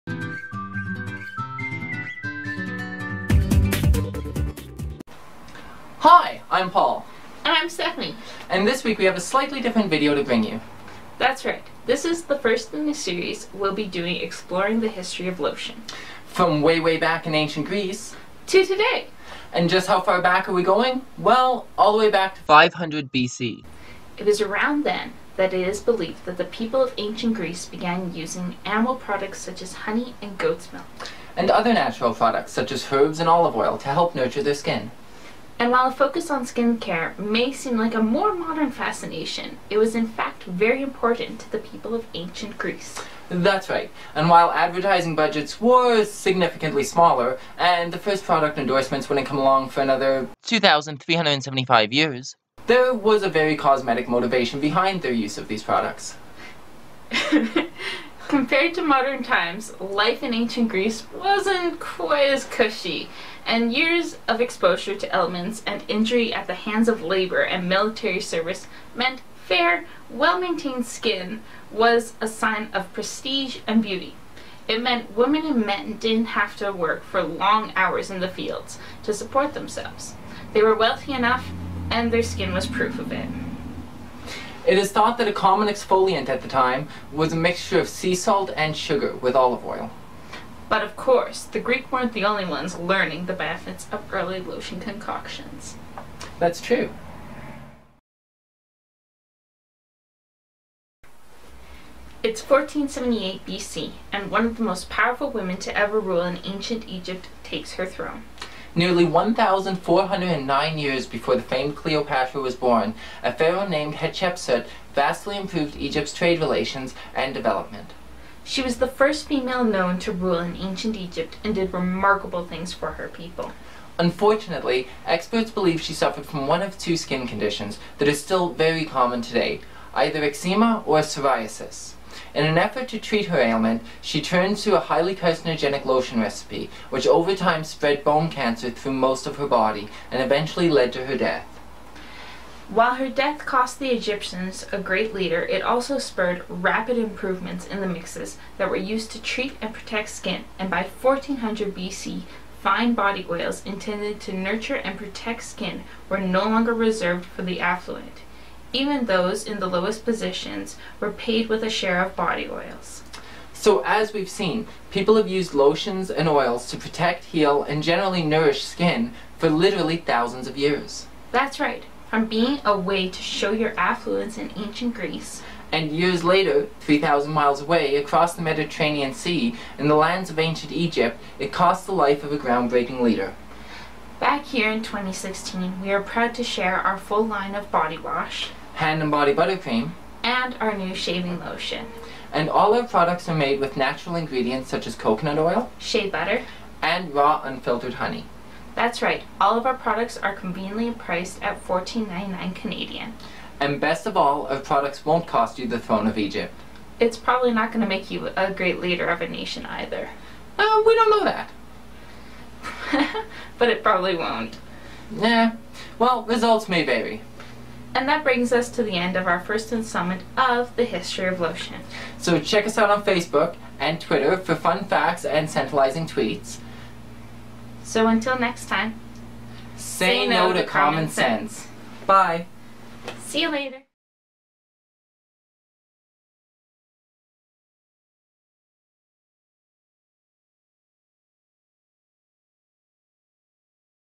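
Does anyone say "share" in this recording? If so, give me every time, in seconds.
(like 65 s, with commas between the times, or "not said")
161 s, 186 s.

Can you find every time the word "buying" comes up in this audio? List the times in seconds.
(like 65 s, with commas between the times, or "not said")
not said.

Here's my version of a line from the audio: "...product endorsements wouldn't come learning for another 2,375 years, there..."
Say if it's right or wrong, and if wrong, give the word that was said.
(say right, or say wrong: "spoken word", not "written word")
wrong: "along", not "learning".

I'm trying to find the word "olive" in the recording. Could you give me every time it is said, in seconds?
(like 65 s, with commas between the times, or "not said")
33 s, 89 s.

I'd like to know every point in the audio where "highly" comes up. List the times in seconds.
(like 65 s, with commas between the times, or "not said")
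134 s.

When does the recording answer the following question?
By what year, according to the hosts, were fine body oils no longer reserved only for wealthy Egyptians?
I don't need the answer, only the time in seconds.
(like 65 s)
151 s.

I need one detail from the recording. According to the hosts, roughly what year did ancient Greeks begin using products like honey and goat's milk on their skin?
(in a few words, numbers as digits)
500 BC.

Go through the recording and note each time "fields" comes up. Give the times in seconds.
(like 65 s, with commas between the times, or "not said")
78 s.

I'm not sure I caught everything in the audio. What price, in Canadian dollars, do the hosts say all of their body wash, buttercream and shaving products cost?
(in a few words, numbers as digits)
$14.99.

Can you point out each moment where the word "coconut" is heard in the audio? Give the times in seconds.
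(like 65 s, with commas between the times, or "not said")
194 s.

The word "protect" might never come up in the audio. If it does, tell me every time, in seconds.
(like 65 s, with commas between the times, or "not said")
149 s, 154 s, 166 s.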